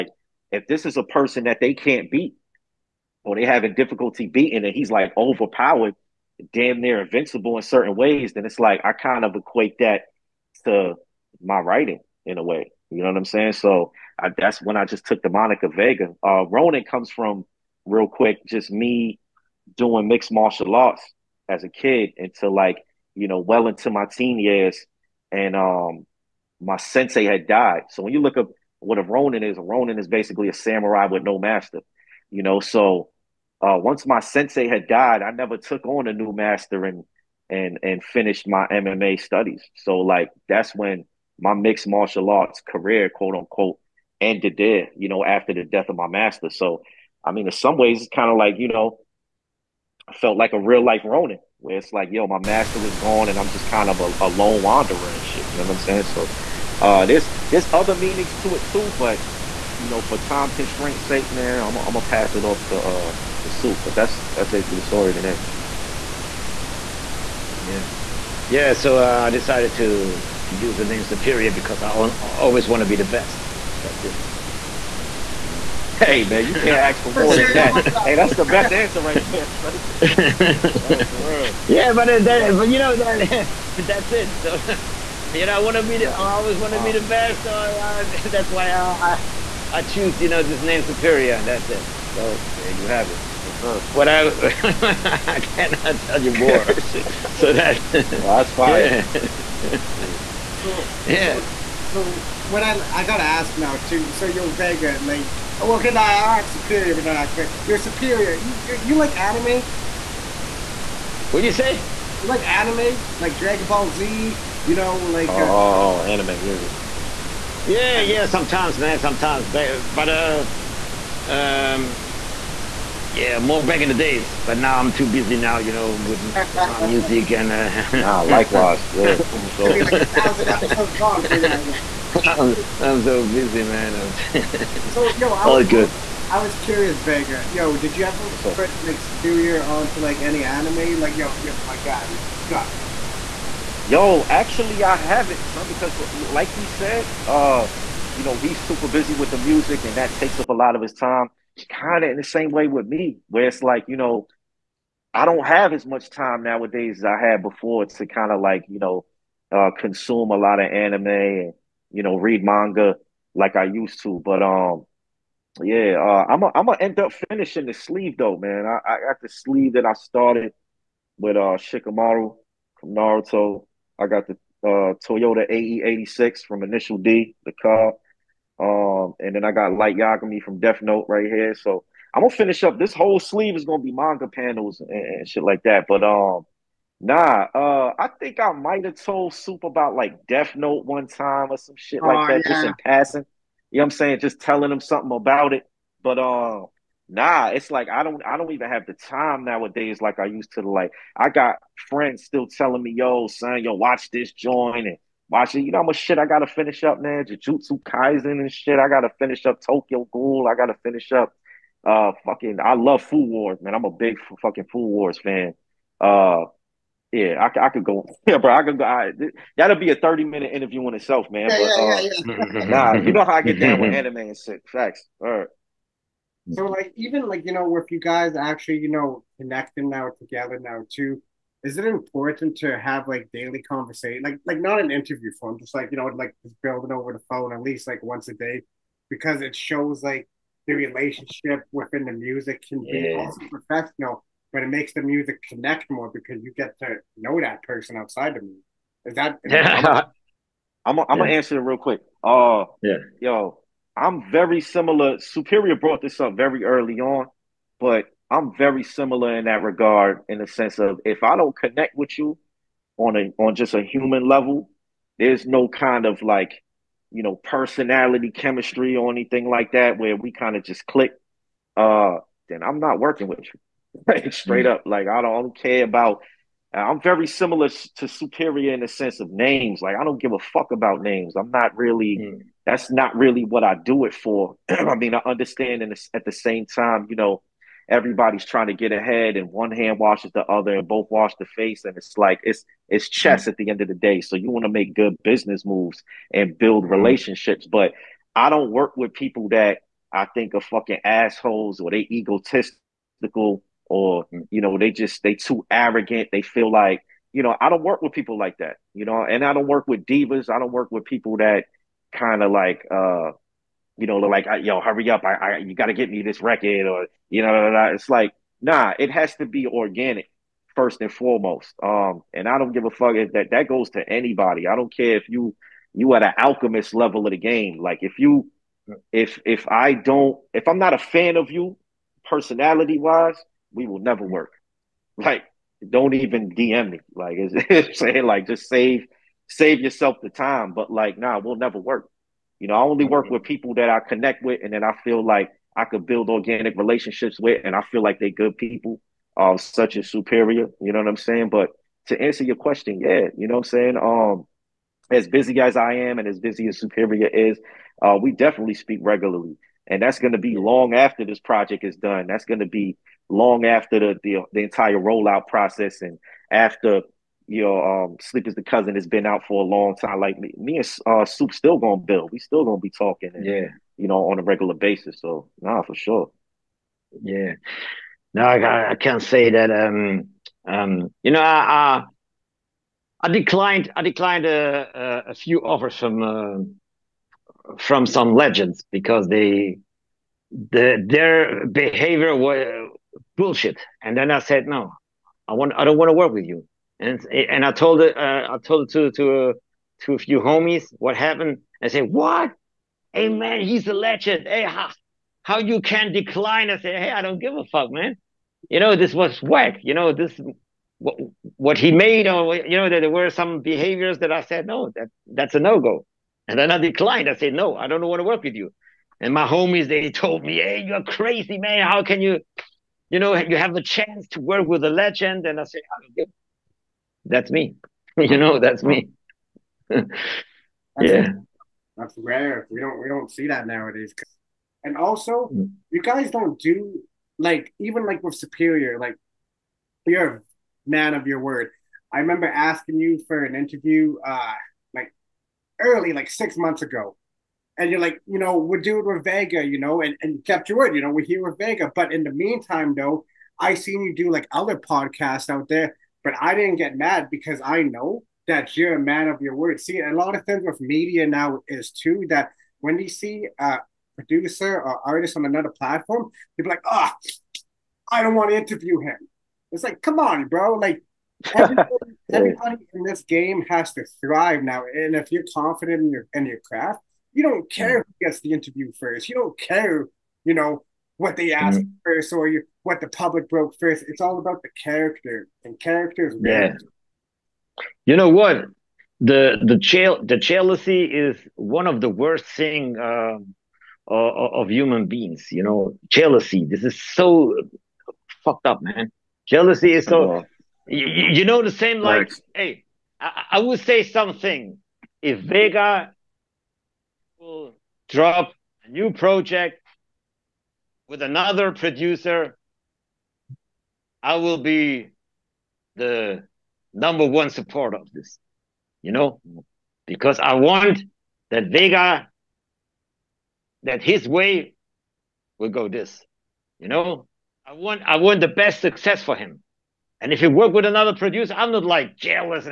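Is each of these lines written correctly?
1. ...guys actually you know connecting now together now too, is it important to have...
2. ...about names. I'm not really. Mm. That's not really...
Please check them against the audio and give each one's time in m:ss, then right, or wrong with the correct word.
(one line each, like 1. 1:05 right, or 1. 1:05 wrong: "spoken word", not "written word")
1. 3:47 right
2. 4:40 right.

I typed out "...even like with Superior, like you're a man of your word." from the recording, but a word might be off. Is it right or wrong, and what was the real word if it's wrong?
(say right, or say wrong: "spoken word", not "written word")
right.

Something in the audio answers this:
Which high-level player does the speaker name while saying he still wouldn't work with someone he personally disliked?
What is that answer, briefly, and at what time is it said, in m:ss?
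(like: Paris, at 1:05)
Alchemist, at 5:26.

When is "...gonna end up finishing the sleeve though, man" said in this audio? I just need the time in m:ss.
2:46.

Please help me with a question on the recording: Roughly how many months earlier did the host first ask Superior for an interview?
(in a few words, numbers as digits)
6.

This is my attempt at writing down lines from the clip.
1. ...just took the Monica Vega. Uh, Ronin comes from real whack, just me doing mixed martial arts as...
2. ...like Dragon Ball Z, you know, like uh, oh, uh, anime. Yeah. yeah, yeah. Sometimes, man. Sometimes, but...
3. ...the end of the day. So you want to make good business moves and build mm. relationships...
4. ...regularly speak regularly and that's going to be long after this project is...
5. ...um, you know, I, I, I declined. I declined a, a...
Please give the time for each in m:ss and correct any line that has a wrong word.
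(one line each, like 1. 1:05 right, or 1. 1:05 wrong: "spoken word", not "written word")
1. 0:14 wrong: "quick", not "whack"
2. 1:53 right
3. 4:53 right
4. 5:58 wrong: "definitely", not "regularly"
5. 6:20 right.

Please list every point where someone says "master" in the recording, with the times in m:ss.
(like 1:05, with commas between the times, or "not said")
0:31, 0:36, 0:46, 0:52.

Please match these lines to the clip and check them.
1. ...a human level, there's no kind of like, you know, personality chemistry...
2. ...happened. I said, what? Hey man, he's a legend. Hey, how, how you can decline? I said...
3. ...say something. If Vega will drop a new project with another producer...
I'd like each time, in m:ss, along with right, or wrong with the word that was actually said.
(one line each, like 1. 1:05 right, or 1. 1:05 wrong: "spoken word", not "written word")
1. 4:23 right
2. 6:41 right
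3. 8:23 right.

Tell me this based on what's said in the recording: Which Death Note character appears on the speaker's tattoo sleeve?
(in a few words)
Light Yagami.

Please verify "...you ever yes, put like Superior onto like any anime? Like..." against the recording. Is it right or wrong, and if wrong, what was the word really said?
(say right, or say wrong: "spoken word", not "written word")
right.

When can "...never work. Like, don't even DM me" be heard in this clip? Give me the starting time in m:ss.
5:33.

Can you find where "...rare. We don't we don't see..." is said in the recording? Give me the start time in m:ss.
7:12.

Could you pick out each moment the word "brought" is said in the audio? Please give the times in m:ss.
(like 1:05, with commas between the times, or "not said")
4:15.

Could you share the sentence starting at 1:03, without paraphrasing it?
But that's that's basically the story today.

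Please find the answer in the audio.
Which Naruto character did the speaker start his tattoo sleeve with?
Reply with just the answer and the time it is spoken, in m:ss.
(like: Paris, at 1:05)
Shikamaru, at 2:51.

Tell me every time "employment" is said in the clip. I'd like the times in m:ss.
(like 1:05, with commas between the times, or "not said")
not said.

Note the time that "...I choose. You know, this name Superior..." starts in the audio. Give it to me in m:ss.
1:29.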